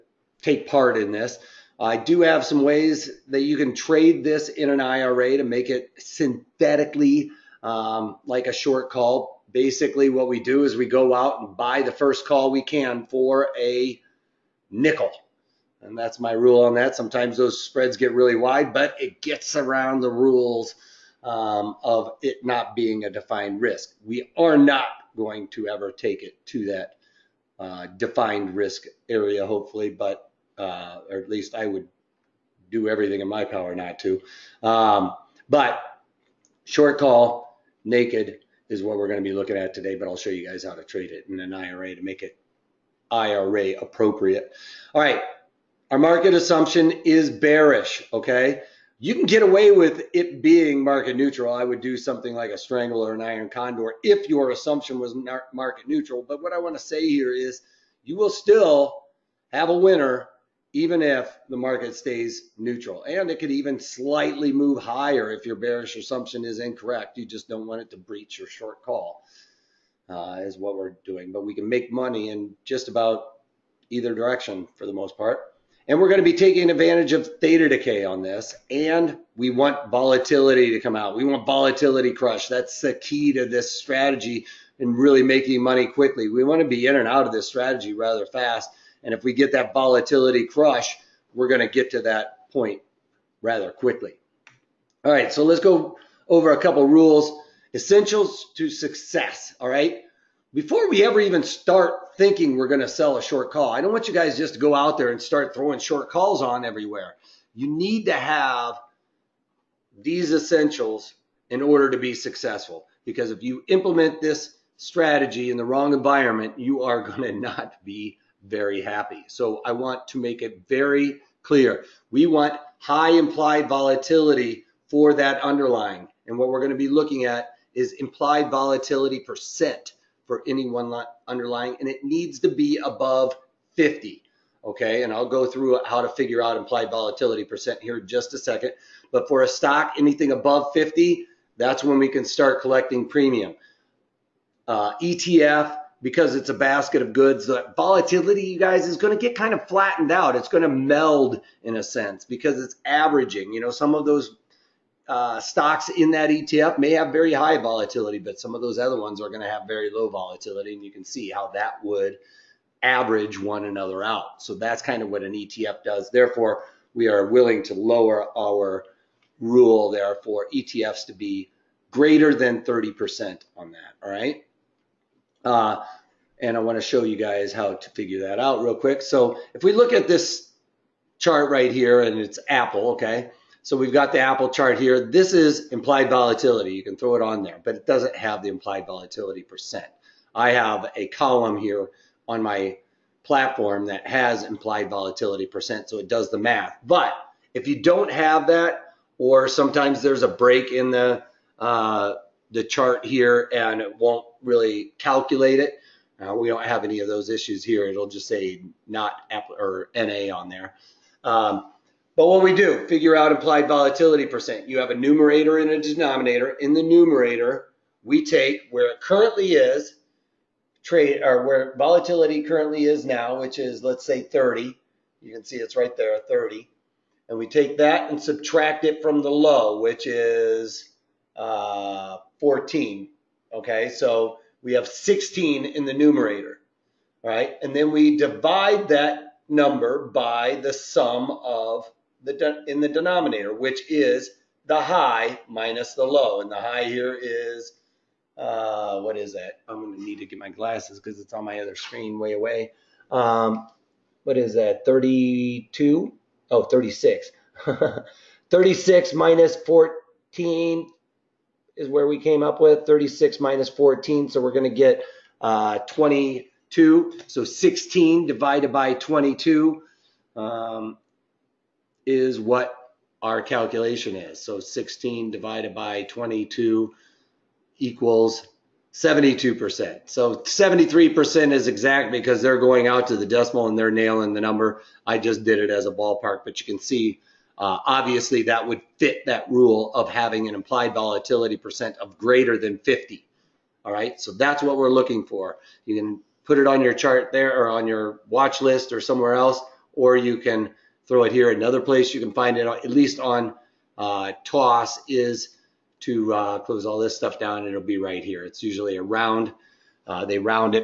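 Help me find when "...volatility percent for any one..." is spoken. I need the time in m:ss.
2:08.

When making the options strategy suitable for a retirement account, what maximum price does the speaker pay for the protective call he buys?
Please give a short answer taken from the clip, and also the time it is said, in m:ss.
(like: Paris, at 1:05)
a nickel, at 0:13.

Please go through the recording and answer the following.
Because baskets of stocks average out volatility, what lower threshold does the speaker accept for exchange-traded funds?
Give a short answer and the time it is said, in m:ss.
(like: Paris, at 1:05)
30%, at 2:51.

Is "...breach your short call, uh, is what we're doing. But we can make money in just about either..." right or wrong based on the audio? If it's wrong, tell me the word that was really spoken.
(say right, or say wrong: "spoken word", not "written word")
right.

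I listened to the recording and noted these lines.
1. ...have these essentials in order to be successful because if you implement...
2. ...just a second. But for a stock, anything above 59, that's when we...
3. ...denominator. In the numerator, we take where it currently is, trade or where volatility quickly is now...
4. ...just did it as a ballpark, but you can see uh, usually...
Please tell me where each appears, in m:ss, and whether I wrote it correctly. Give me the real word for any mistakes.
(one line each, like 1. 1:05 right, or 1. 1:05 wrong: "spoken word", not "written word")
1. 1:48 right
2. 2:18 wrong: "50", not "59"
3. 3:35 wrong: "currently", not "quickly"
4. 4:45 wrong: "obviously", not "usually".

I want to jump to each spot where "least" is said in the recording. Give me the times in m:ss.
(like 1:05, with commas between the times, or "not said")
0:31, 5:02.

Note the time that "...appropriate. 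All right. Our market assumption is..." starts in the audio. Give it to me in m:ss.
0:43.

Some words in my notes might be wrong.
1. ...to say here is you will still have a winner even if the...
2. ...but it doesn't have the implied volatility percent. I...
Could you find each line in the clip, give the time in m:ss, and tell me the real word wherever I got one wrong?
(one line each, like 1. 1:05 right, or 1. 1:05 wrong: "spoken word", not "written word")
1. 0:56 right
2. 3:07 right.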